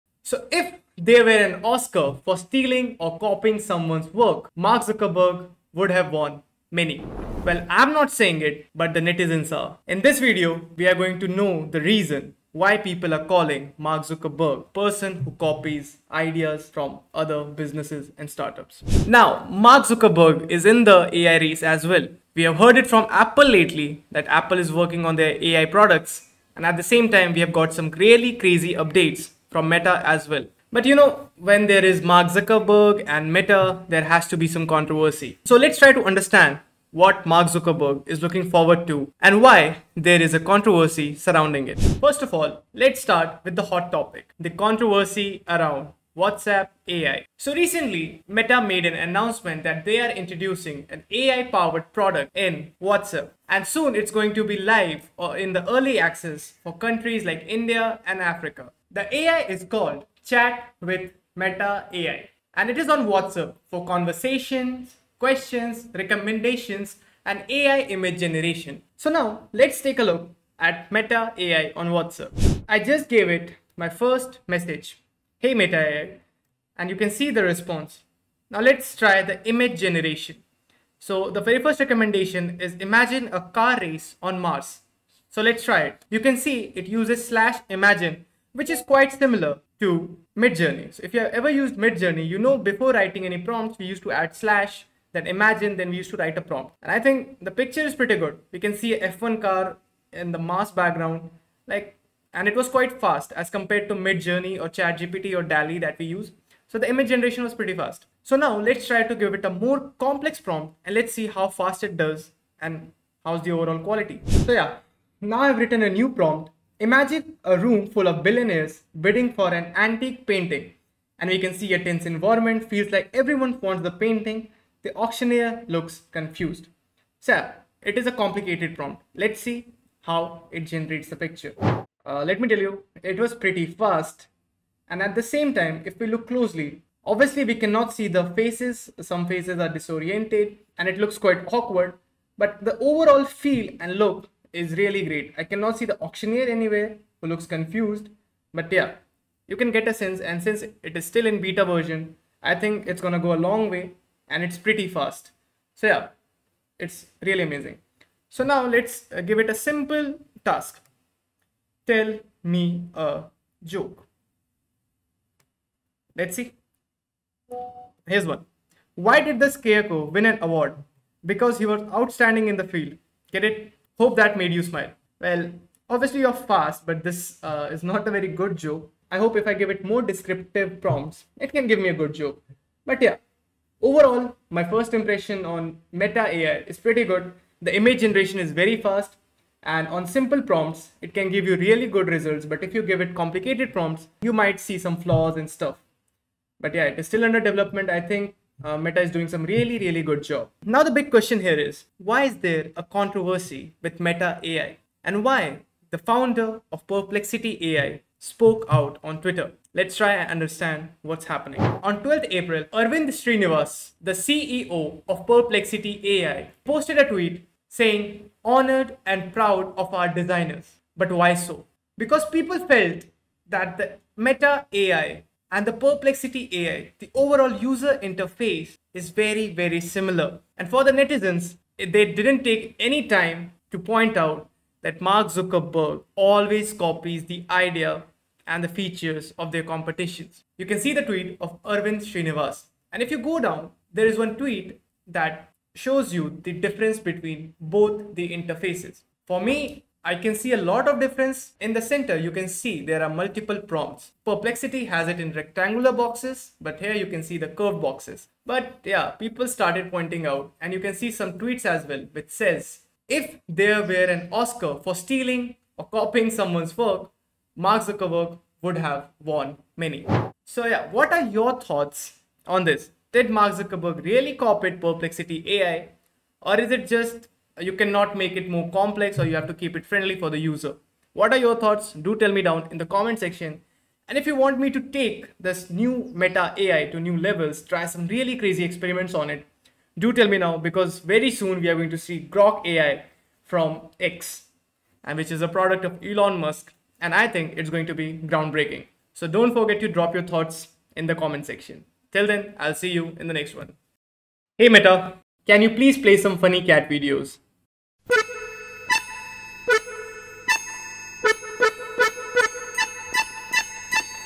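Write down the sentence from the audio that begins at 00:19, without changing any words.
Now, Mark Zuckerberg is in the AI race as well.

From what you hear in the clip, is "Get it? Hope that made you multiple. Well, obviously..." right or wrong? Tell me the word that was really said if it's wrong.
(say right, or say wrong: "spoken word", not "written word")
wrong: "smile", not "multiple".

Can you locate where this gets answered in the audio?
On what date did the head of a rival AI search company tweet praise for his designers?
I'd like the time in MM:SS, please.
03:32.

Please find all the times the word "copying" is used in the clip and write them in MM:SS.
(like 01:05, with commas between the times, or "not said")
00:03, 04:25.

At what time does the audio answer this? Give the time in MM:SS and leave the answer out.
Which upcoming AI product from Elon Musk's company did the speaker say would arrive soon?
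04:52.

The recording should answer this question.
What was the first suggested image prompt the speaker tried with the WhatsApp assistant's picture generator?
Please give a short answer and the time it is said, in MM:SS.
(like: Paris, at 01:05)
A car race on Mars, at 01:23.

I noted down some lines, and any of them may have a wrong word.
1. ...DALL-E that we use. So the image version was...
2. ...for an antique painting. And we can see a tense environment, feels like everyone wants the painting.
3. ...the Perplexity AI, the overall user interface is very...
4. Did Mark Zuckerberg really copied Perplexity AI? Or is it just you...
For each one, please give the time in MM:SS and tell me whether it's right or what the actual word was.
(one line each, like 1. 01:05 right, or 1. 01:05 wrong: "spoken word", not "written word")
1. 01:45 wrong: "generation", not "version"
2. 01:59 right
3. 03:45 right
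4. 04:33 right.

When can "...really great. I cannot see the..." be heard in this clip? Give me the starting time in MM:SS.
02:24.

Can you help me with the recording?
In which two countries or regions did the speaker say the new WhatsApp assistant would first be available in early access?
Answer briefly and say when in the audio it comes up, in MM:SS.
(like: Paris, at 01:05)
India and Africa, at 00:57.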